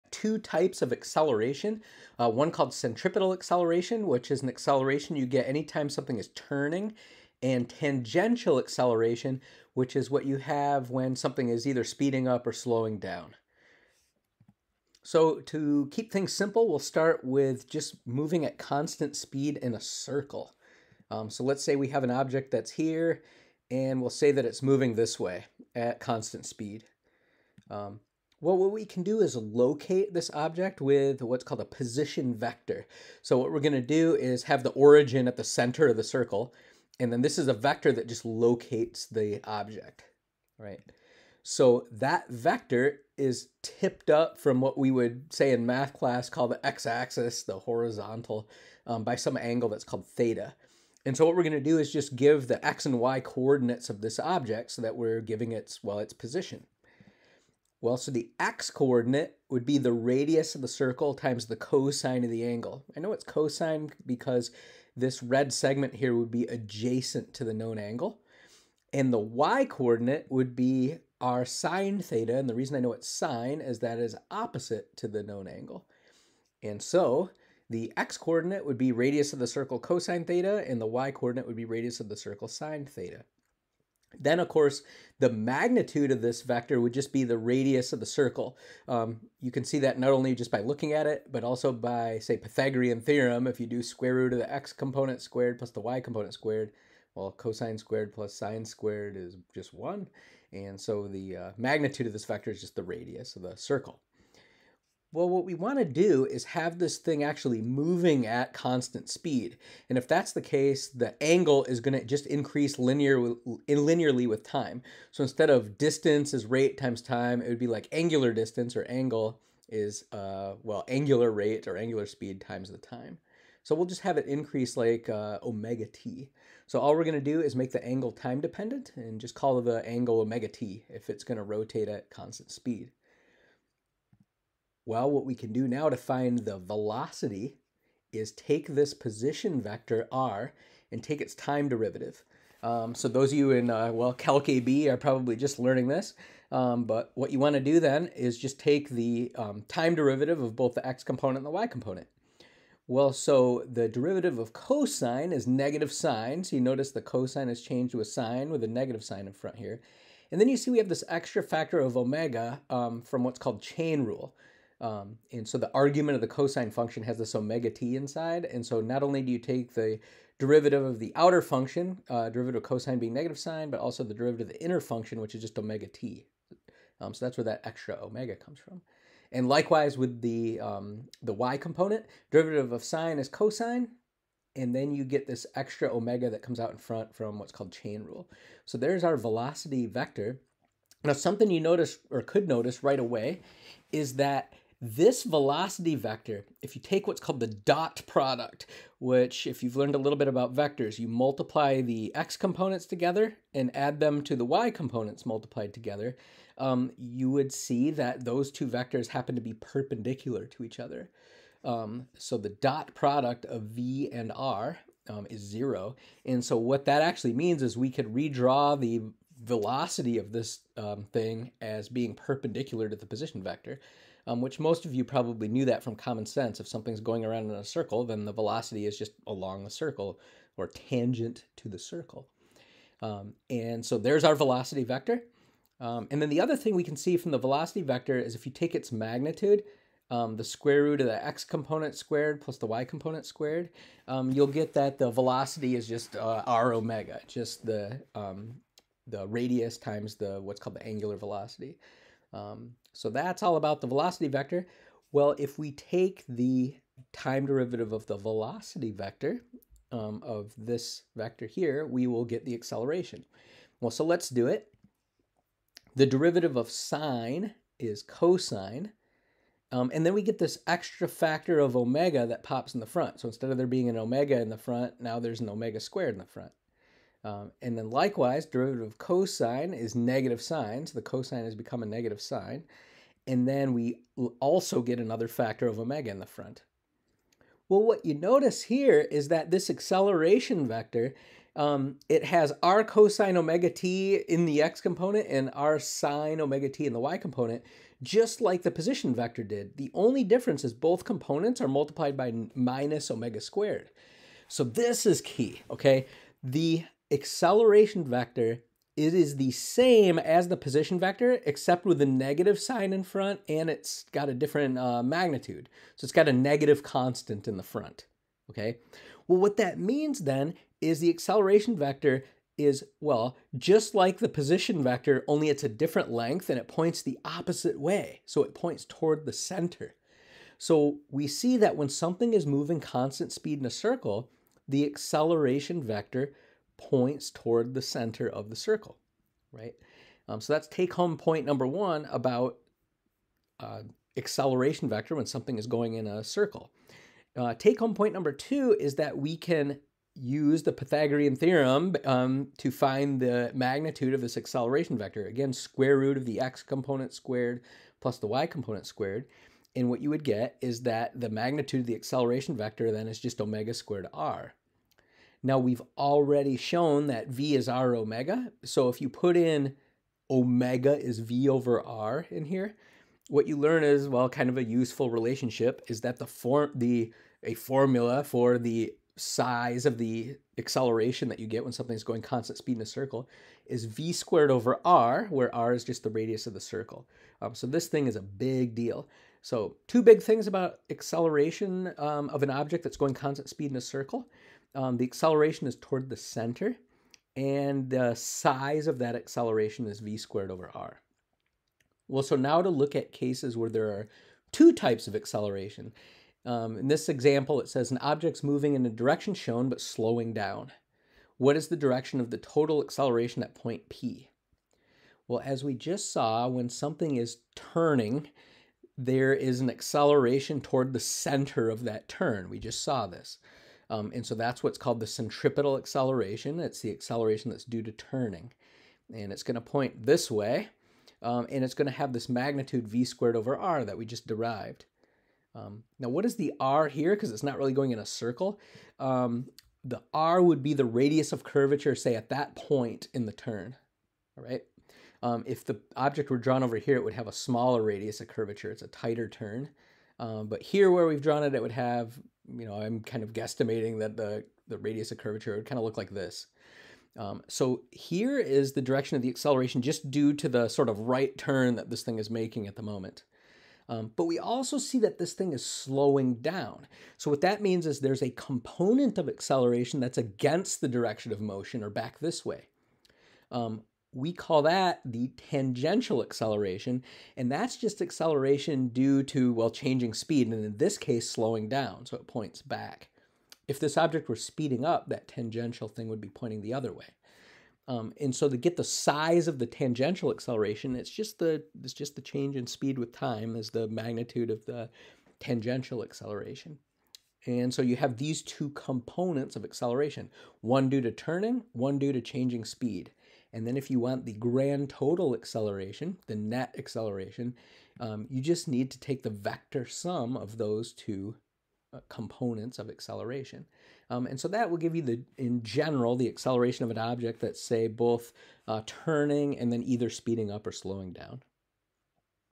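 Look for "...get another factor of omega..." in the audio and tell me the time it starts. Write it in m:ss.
4:44.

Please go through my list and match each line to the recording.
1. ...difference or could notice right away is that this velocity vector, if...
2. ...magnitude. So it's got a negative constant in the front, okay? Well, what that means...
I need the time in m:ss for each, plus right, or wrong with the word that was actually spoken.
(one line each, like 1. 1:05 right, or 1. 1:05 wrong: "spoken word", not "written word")
1. 3:11 wrong: "notice", not "difference"
2. 5:15 right.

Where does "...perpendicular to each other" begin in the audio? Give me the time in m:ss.
3:29.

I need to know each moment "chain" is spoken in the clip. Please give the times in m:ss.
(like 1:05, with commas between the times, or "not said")
2:43, 3:07.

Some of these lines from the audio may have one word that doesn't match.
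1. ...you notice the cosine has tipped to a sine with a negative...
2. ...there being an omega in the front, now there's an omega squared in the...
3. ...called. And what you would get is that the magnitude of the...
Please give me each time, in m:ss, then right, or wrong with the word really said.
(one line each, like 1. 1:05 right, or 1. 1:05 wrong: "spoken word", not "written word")
1. 2:36 wrong: "changed", not "tipped"
2. 4:33 right
3. 5:58 wrong: "squared", not "called".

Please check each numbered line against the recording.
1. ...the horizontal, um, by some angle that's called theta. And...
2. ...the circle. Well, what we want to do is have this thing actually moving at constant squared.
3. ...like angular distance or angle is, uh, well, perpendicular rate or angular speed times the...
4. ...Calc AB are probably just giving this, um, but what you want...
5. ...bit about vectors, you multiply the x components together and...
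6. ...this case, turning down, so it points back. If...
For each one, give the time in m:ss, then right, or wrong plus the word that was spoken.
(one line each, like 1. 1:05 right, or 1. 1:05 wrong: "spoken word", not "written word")
1. 0:47 right
2. 1:43 wrong: "speed", not "squared"
3. 1:57 wrong: "angular", not "perpendicular"
4. 2:24 wrong: "learning", not "giving"
5. 3:20 right
6. 8:00 wrong: "slowing", not "turning".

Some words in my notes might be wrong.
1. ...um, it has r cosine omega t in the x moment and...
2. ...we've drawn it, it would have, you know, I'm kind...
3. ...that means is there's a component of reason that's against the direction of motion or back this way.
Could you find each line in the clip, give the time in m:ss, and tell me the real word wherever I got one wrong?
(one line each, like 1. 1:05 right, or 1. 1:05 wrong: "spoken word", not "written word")
1. 4:51 wrong: "component", not "moment"
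2. 7:31 right
3. 7:47 wrong: "acceleration", not "reason".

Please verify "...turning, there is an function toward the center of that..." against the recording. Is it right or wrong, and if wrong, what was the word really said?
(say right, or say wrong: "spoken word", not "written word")
wrong: "acceleration", not "function".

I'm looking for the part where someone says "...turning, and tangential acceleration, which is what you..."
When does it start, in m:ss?
0:06.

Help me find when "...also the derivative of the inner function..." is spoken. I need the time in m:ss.
2:53.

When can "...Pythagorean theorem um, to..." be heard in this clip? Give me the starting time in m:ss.
5:50.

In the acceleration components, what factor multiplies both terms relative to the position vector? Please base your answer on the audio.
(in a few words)
minus omega squared.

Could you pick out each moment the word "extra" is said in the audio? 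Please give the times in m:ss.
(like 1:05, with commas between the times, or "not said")
2:41, 2:57, 3:05, 4:30.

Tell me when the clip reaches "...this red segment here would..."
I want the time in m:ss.
1:04.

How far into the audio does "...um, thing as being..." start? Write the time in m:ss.
3:40.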